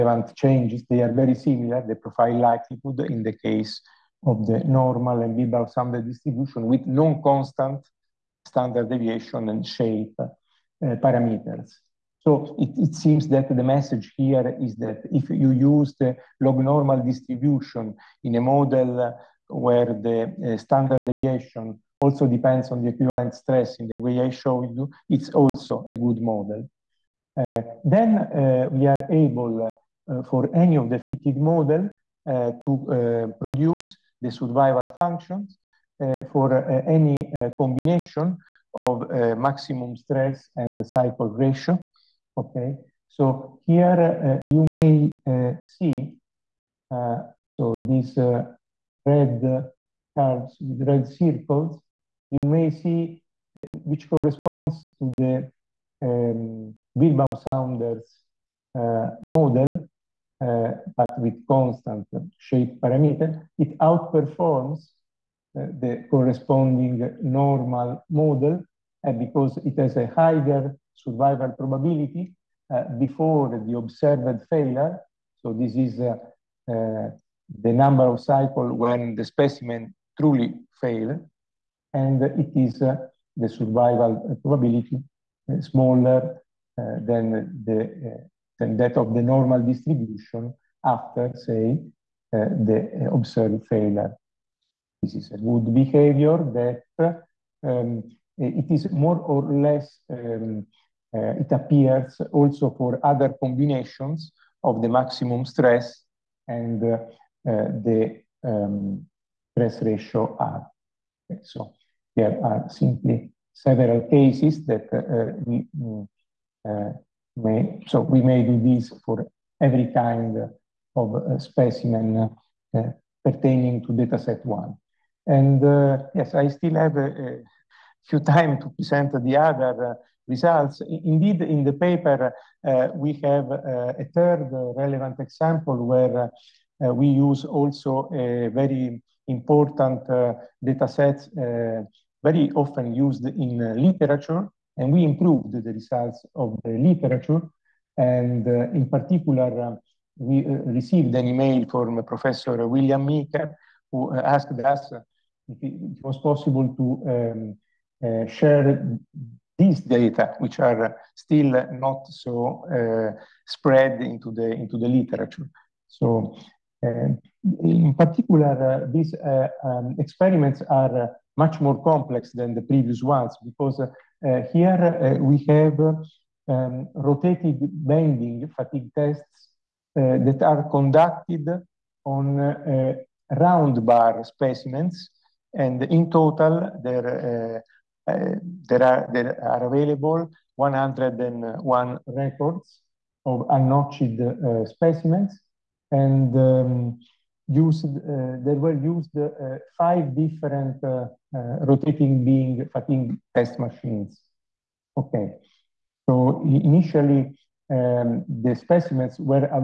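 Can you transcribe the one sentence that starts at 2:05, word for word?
And uh, yes, I still have a, a, few time to present the other uh, results.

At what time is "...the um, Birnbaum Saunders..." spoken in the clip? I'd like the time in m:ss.
0:55.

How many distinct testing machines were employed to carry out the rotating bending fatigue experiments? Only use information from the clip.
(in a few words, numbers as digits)
5.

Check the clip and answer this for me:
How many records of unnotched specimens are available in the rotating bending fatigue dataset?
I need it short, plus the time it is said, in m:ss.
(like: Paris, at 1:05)
101, at 3:10.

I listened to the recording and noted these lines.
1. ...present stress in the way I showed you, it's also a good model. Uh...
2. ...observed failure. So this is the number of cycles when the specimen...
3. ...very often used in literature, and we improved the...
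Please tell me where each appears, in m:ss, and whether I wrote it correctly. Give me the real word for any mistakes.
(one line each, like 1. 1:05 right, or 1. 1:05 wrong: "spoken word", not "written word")
1. 0:22 wrong: "equivalent", not "present"
2. 1:13 right
3. 2:22 right.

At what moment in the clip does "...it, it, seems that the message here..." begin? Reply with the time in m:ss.
0:12.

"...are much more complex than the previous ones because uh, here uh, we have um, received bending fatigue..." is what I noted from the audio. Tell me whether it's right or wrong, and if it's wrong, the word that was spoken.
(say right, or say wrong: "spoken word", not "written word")
wrong: "rotated", not "received".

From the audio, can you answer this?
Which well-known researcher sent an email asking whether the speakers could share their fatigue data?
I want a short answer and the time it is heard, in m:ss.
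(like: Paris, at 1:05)
William Meeker, at 2:32.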